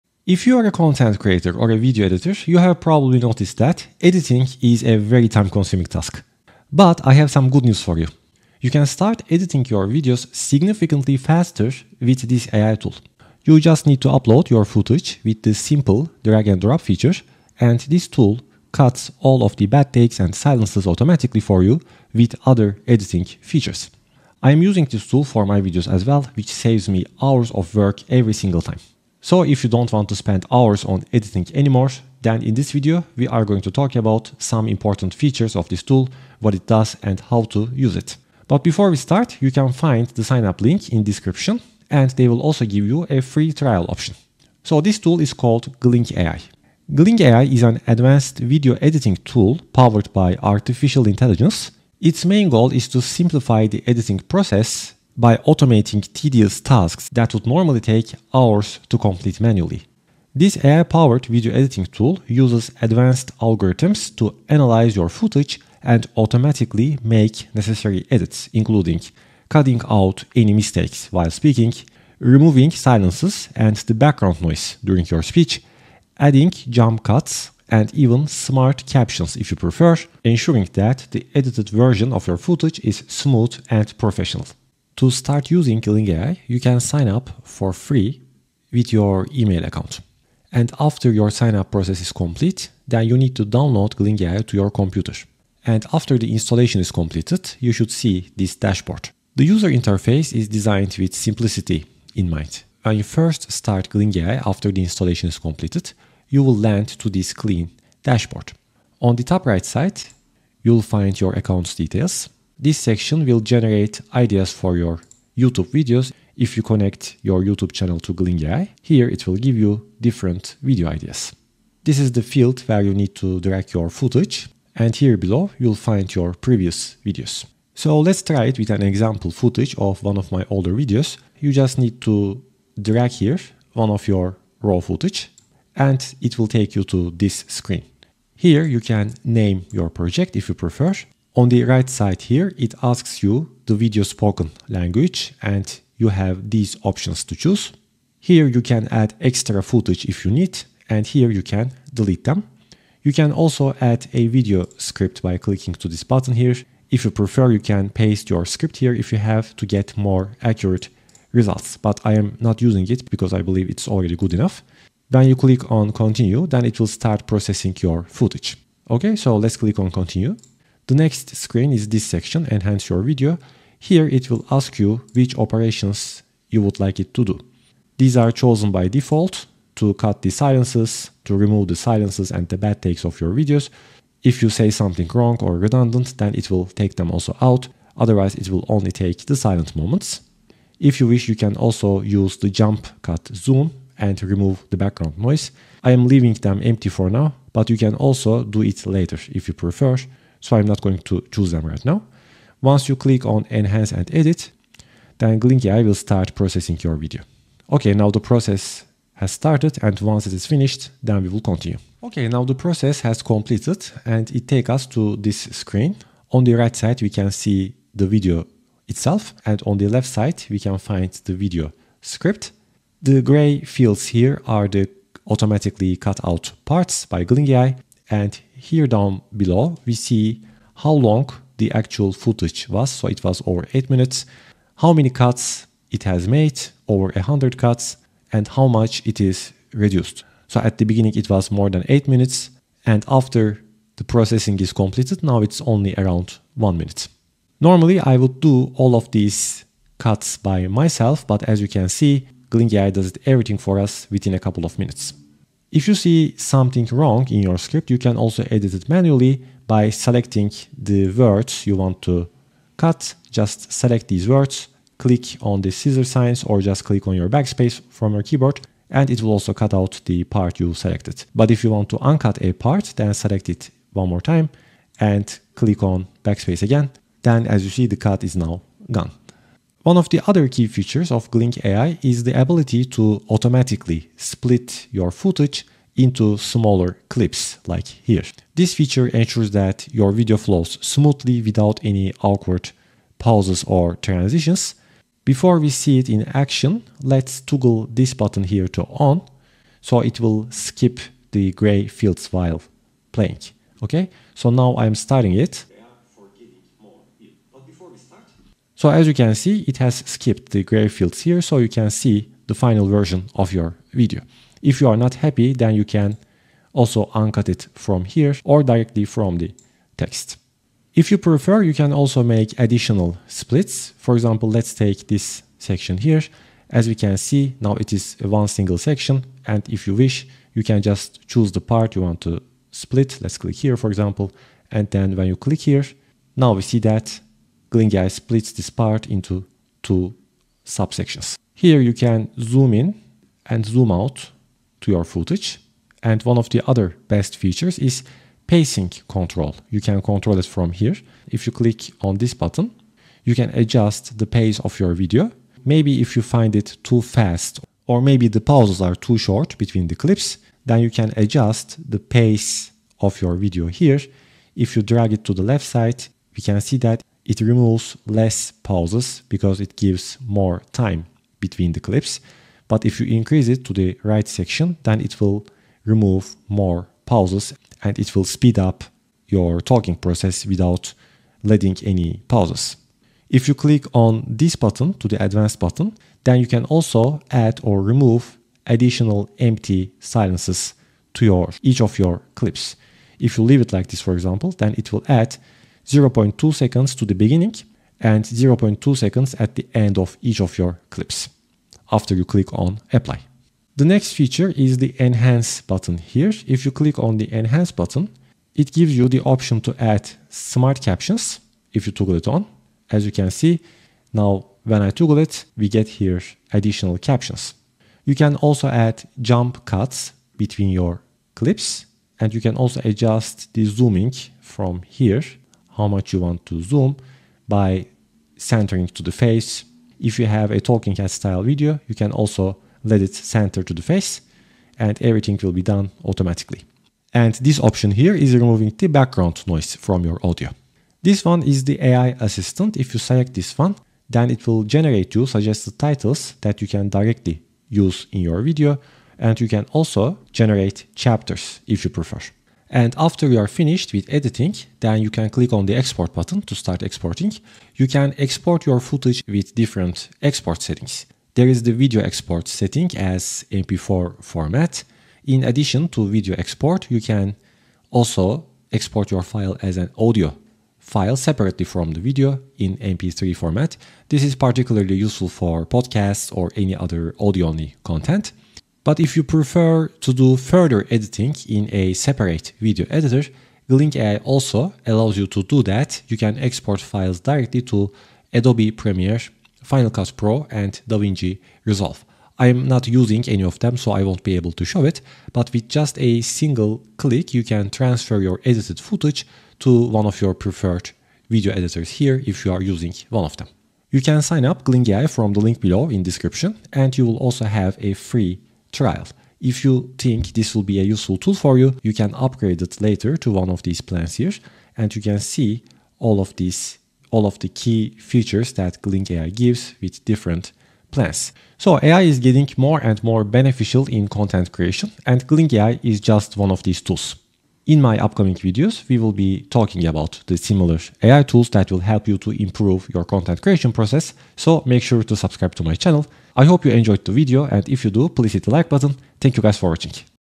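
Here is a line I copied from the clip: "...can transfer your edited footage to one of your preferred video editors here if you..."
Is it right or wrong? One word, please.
right.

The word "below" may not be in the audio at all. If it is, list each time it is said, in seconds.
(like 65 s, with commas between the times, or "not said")
125 s, 229 s, 505 s.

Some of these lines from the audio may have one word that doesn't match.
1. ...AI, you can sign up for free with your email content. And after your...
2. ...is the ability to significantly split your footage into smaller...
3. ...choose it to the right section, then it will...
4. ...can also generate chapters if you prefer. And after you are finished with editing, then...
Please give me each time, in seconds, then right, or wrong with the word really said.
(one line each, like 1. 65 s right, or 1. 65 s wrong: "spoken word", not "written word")
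1. 86 s wrong: "account", not "content"
2. 282 s wrong: "automatically", not "significantly"
3. 373 s wrong: "increase", not "choose"
4. 449 s right.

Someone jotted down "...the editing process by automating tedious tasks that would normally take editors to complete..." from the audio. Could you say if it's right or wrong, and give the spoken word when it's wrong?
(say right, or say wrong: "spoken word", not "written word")
wrong: "hours", not "editors".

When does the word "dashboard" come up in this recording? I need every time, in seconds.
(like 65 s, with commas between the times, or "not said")
98 s, 108 s.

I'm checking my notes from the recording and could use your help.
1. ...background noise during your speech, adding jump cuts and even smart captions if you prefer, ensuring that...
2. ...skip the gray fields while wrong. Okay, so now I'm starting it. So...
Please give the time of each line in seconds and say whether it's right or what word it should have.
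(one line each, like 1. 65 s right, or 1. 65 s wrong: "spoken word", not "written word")
1. 73 s right
2. 300 s wrong: "playing", not "wrong".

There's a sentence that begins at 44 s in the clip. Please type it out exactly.
So this tool is called Gling AI.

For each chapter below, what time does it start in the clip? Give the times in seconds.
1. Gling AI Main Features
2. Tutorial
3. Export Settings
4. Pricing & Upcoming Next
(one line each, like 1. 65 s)
1. 45 s
2. 85 s
3. 453 s
4. 504 s.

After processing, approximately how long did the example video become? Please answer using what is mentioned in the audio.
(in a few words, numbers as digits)
around 1 minute.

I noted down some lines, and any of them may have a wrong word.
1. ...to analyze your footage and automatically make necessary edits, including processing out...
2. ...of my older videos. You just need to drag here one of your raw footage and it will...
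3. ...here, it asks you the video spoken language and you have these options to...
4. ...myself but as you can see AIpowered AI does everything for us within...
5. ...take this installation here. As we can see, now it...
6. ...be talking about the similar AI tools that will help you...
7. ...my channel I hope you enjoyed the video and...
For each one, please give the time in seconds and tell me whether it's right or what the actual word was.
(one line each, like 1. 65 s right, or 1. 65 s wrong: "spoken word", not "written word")
1. 64 s wrong: "cutting", not "processing"
2. 130 s right
3. 142 s right
4. 250 s wrong: "Gling", not "AIpowered"
5. 324 s wrong: "section", not "installation"
6. 529 s right
7. 535 s right.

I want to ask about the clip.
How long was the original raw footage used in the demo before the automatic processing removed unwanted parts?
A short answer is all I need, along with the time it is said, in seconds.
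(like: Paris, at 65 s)
over 8 minutes, at 233 s.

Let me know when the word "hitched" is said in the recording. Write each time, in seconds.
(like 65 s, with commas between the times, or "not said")
not said.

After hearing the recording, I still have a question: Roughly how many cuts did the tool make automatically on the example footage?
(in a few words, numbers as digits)
over 100.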